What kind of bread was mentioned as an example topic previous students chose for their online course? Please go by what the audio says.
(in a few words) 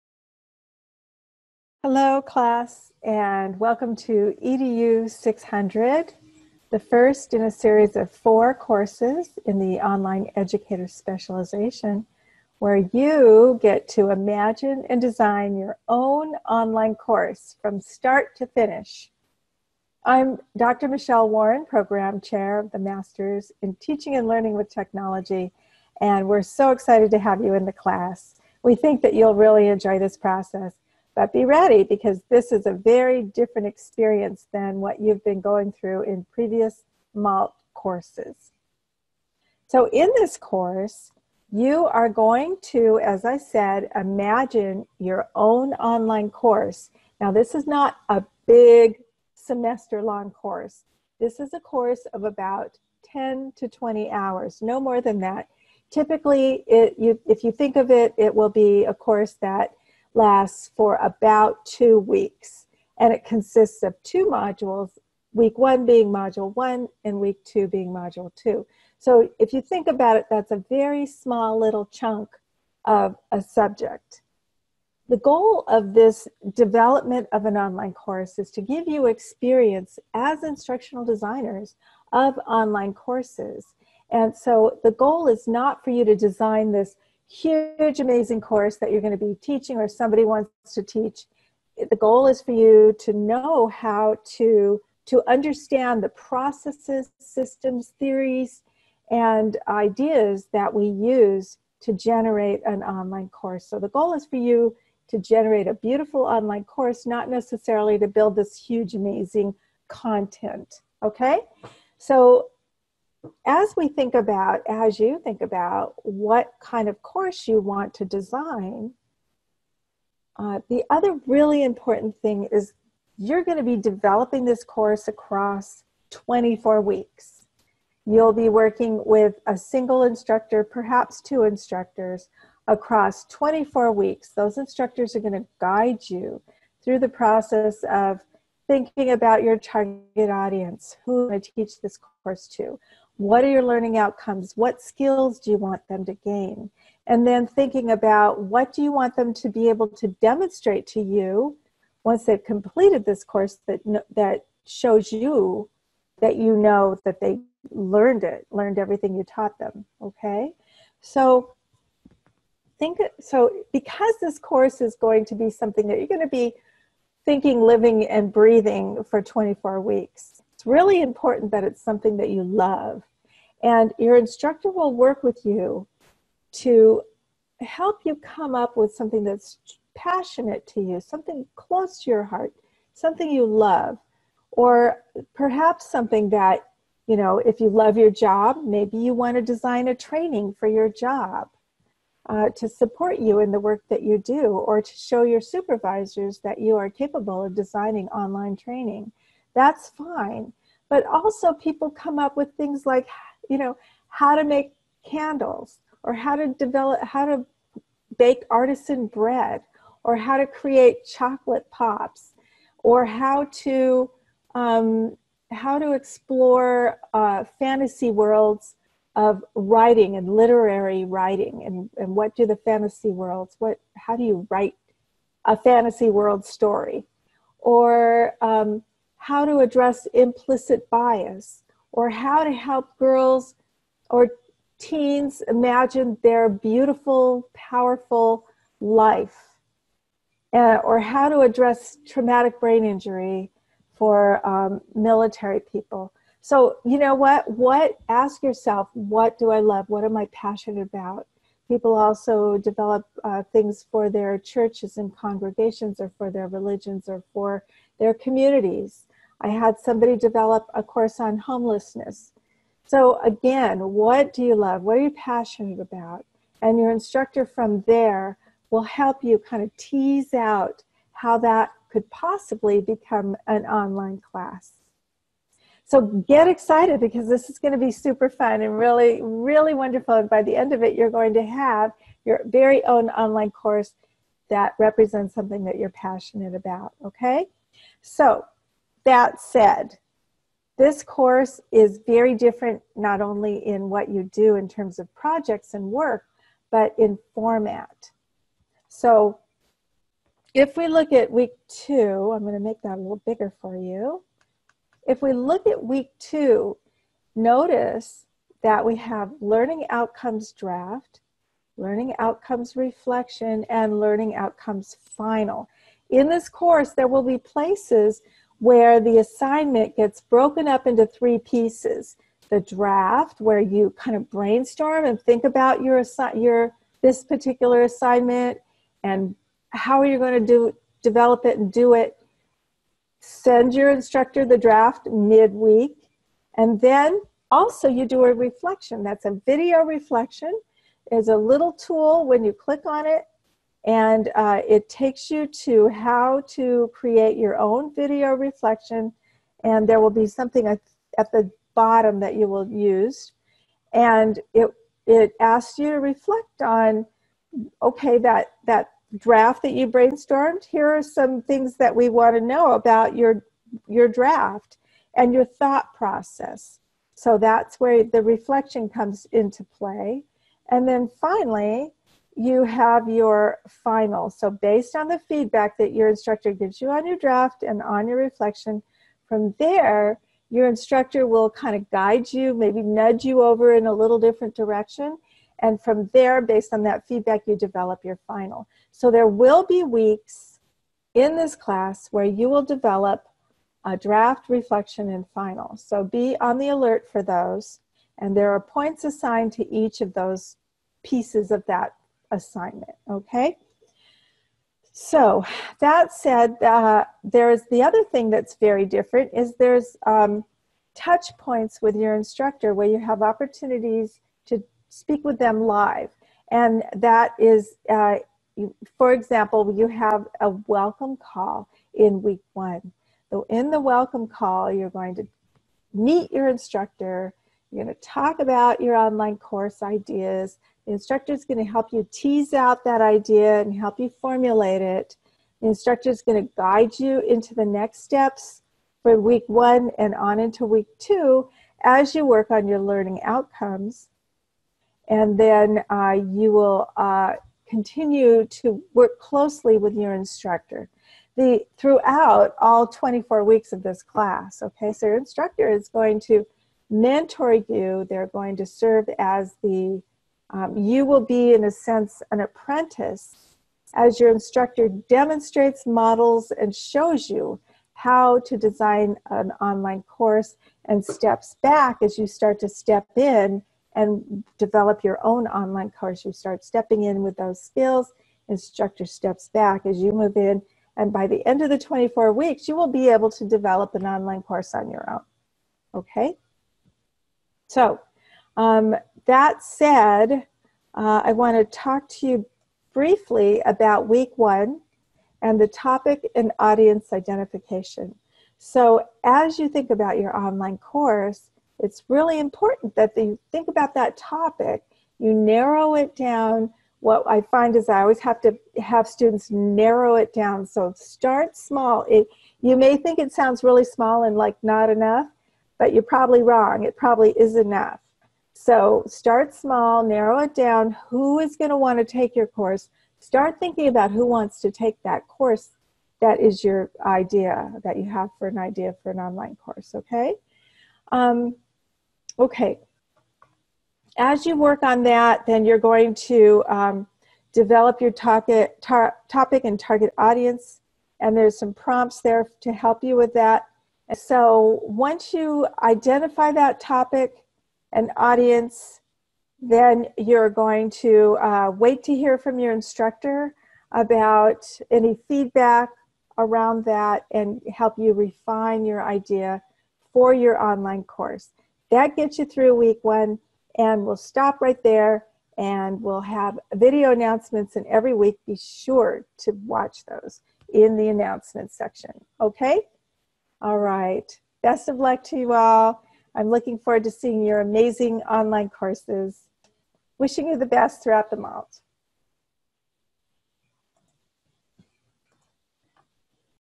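artisan bread.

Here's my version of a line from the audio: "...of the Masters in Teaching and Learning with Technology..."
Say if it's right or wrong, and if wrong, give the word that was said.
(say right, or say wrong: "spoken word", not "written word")
right.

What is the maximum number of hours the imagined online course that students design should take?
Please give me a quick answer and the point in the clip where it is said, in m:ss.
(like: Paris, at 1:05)
20 hours, at 0:53.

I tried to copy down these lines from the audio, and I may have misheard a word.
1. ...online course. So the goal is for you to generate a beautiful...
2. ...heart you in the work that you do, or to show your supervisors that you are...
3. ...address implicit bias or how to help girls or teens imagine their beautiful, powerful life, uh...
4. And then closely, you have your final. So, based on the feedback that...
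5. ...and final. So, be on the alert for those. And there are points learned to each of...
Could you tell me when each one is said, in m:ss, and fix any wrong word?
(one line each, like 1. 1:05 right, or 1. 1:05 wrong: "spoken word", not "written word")
1. 1:42 right
2. 3:12 wrong: "support", not "heart"
3. 3:49 right
4. 6:10 wrong: "finally", not "closely"
5. 6:35 wrong: "assigned", not "learned".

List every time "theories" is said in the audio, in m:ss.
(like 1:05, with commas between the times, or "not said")
1:37.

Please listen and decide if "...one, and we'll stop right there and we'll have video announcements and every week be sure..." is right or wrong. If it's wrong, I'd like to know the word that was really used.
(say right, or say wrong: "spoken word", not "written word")
right.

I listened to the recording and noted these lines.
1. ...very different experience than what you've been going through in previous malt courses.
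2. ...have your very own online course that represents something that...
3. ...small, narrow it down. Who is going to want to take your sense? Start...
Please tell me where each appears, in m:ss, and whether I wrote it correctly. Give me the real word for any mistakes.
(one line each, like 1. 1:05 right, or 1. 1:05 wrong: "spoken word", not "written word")
1. 0:32 right
2. 4:41 right
3. 8:39 wrong: "course", not "sense".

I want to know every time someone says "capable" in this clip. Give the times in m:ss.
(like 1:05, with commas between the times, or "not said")
3:16.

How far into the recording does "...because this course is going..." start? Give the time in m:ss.
2:43.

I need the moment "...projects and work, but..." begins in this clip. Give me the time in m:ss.
4:55.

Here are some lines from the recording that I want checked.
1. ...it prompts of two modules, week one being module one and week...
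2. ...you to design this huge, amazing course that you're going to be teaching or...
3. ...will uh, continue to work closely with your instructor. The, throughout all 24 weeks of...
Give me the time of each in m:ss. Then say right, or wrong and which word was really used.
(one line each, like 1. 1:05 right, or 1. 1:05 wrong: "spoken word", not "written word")
1. 1:03 wrong: "consists", not "prompts"
2. 1:25 right
3. 7:26 right.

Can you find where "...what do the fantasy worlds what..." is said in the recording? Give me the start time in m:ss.
3:42.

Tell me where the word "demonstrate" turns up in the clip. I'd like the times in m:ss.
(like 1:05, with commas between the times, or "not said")
2:30, 7:44.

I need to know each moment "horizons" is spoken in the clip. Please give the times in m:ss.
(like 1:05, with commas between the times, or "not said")
not said.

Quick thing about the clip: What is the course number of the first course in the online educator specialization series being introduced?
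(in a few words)
EDU 600.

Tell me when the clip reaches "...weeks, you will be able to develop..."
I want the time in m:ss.
8:02.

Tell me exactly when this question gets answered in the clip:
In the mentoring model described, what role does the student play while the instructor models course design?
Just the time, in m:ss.
7:42.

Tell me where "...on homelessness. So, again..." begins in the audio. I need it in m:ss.
4:21.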